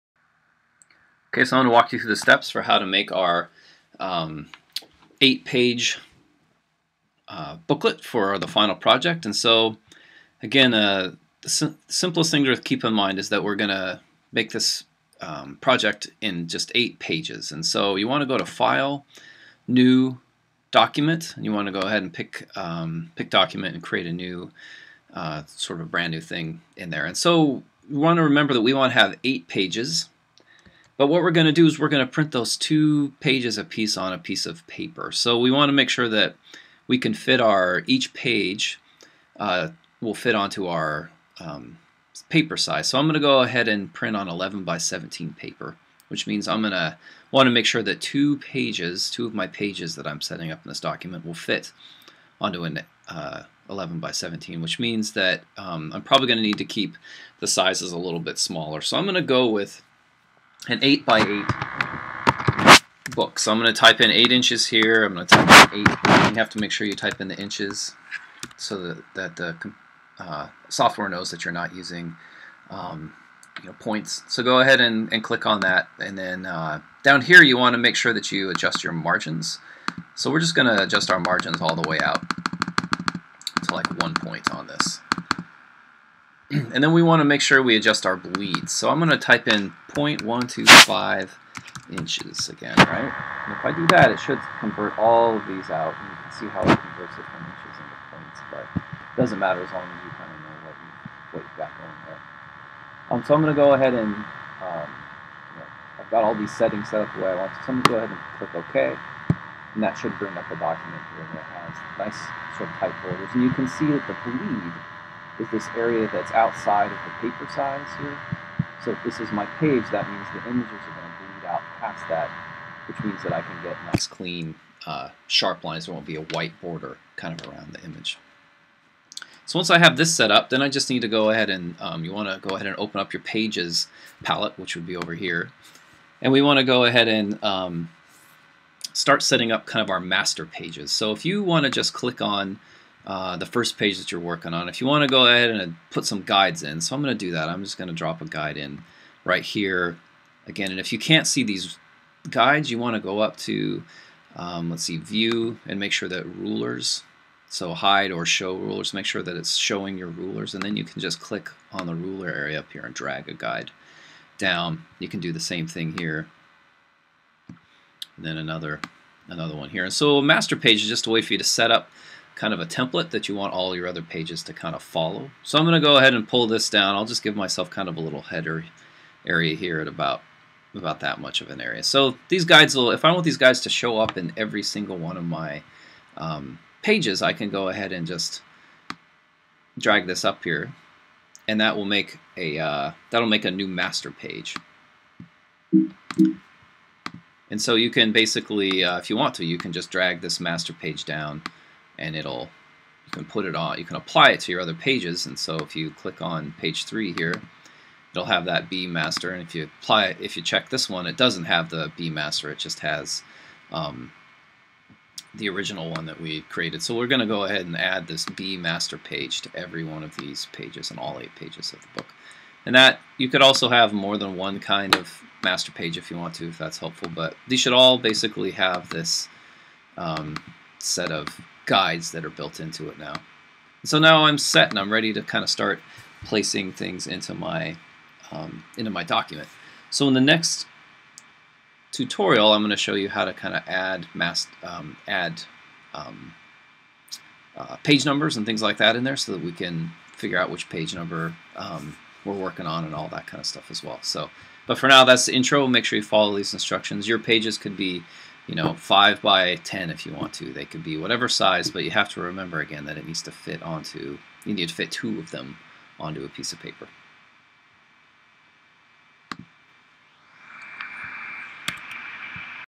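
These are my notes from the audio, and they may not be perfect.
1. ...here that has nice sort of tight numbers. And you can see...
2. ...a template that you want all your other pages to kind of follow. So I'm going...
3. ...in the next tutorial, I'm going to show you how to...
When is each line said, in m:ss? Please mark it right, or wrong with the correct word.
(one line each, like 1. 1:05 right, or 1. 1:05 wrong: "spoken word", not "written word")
1. 1:51 wrong: "borders", not "numbers"
2. 2:52 right
3. 4:00 right.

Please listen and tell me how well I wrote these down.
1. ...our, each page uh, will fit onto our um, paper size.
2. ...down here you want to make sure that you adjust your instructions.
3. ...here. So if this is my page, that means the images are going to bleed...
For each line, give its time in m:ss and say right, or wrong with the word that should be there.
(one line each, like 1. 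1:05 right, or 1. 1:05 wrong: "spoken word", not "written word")
1. 0:37 right
2. 1:17 wrong: "margins", not "instructions"
3. 1:57 right.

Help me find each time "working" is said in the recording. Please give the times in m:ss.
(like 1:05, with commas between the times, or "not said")
2:24, 4:12.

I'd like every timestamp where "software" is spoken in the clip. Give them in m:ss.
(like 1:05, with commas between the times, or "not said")
1:10.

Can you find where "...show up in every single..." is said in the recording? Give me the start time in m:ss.
3:03.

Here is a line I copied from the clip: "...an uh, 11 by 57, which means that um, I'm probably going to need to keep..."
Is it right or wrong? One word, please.
wrong.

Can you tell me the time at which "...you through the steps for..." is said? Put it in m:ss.
0:01.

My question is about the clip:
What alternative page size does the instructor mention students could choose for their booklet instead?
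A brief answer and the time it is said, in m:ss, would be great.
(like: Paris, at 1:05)
5 by 10, at 4:18.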